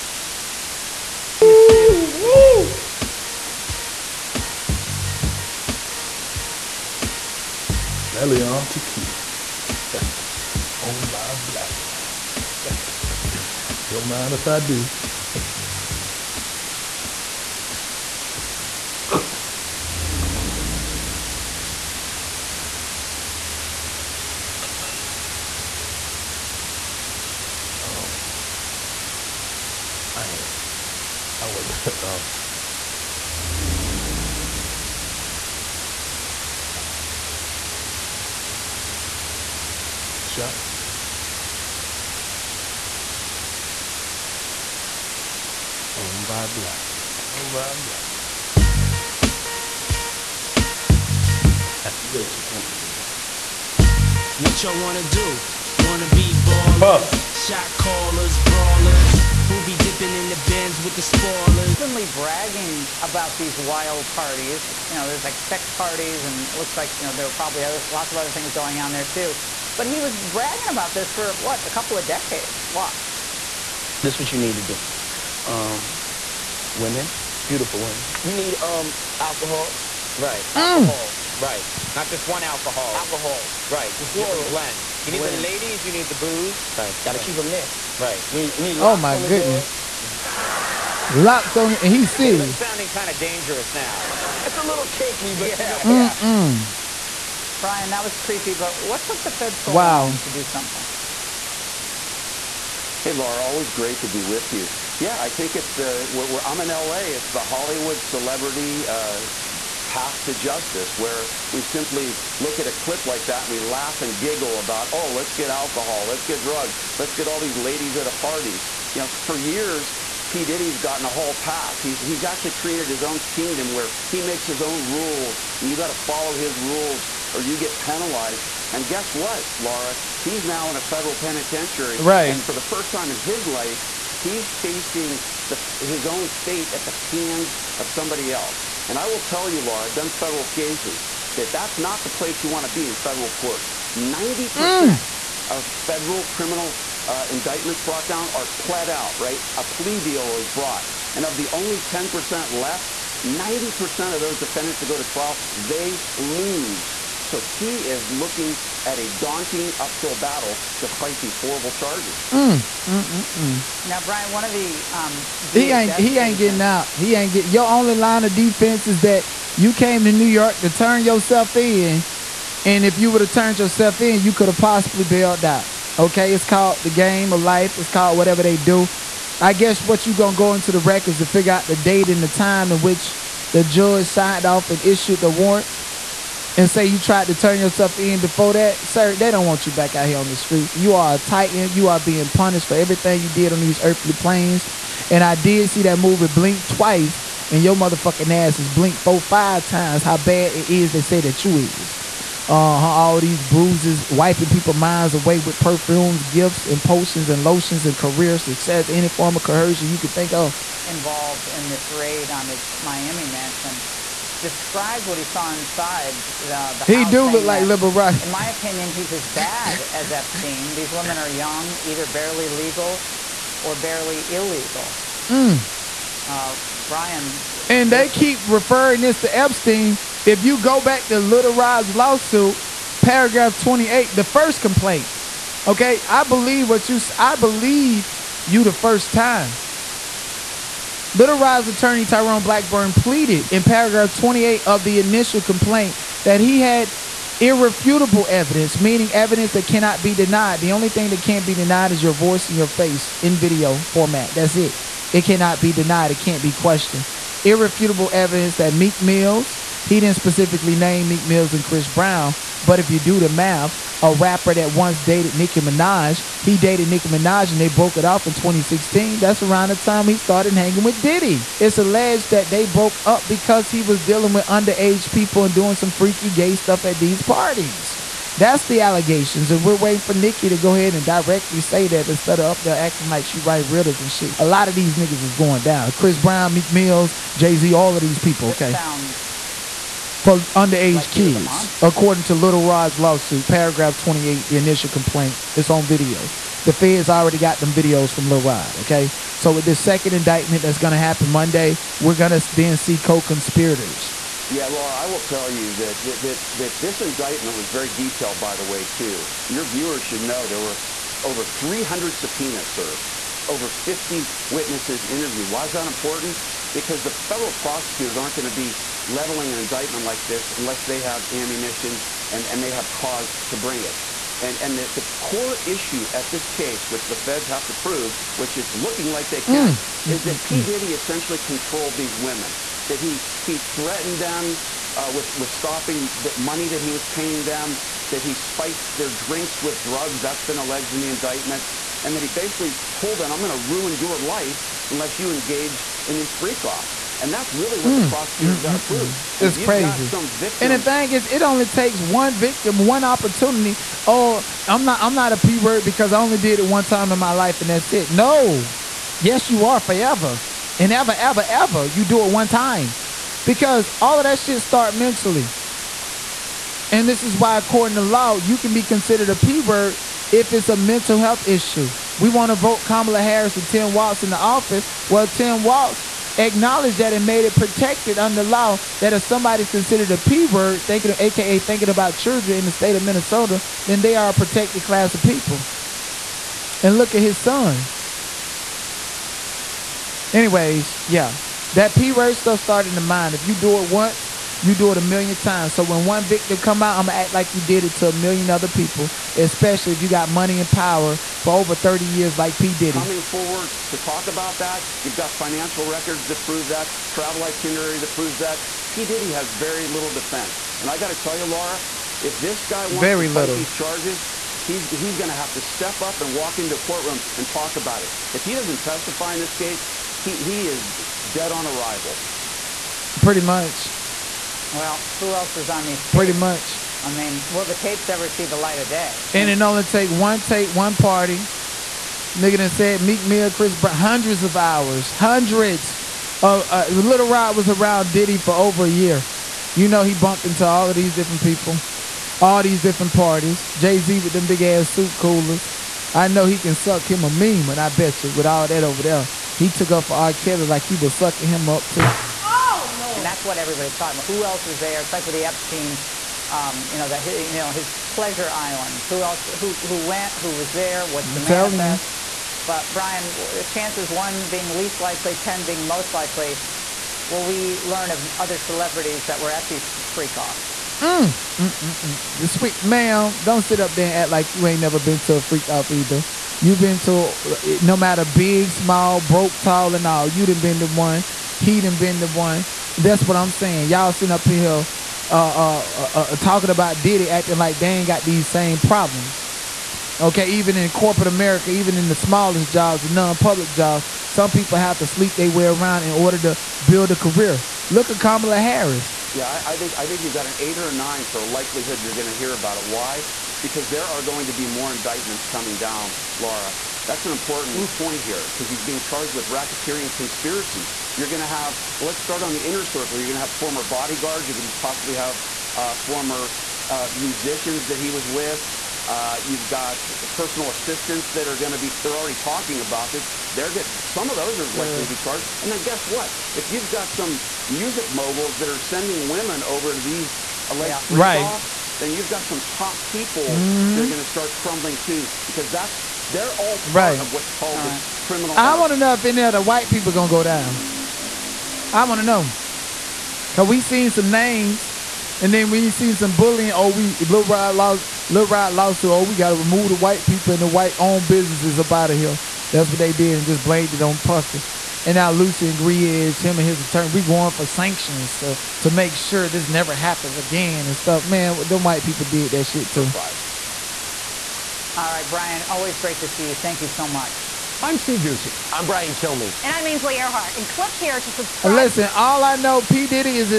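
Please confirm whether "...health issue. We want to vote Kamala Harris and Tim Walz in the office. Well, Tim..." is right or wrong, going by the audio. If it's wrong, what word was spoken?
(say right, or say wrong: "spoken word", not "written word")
right.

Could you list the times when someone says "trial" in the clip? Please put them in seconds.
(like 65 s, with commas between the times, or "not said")
155 s.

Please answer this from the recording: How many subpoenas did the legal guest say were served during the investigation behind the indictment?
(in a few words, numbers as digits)
300.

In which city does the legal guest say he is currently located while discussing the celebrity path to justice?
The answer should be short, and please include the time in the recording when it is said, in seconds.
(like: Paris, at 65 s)
LA, at 106 s.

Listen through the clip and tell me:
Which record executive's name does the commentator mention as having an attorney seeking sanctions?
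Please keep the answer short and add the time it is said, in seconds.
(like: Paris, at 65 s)
Lucian Grainge, at 555 s.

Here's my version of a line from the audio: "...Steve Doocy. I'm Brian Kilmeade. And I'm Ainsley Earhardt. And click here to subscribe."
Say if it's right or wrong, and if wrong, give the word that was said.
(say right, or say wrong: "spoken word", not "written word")
right.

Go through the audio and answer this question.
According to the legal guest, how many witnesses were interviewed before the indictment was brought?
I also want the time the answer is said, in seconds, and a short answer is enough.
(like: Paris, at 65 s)
50, at 313 s.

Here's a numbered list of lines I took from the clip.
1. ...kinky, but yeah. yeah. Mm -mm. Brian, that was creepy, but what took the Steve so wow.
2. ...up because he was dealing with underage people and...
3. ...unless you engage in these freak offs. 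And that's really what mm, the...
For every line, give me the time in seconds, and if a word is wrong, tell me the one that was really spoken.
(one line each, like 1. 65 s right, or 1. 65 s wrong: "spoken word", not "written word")
1. 94 s wrong: "Fed", not "Steve"
2. 273 s right
3. 344 s right.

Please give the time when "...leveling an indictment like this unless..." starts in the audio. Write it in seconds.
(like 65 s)
319 s.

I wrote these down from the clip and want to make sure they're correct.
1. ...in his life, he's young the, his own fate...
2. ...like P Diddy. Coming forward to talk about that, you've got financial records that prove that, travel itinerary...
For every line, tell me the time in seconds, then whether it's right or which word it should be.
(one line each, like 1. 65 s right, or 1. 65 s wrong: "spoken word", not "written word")
1. 133 s wrong: "facing", not "young"
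2. 402 s right.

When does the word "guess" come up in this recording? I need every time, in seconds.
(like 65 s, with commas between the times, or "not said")
128 s, 179 s, 525 s.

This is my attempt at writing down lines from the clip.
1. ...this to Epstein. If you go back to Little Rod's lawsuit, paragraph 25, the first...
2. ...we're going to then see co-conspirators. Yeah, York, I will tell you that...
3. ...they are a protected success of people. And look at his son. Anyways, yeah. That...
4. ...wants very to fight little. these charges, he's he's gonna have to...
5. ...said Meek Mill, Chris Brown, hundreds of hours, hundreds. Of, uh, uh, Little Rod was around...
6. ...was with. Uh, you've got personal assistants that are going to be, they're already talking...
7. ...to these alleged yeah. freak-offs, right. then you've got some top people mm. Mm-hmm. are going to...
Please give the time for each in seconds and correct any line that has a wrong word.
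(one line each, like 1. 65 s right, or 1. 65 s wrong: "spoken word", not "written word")
1. 229 s wrong: "28", not "25"
2. 301 s wrong: "Laura", not "York"
3. 384 s wrong: "class", not "success"
4. 412 s right
5. 432 s right
6. 518 s right
7. 529 s right.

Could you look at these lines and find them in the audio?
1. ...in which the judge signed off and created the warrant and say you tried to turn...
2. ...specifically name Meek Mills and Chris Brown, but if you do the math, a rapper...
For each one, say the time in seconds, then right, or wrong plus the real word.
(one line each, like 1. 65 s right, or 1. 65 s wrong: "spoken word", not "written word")
1. 182 s wrong: "issued", not "created"
2. 260 s right.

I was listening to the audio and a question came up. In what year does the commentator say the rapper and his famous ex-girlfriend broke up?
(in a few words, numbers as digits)
2016.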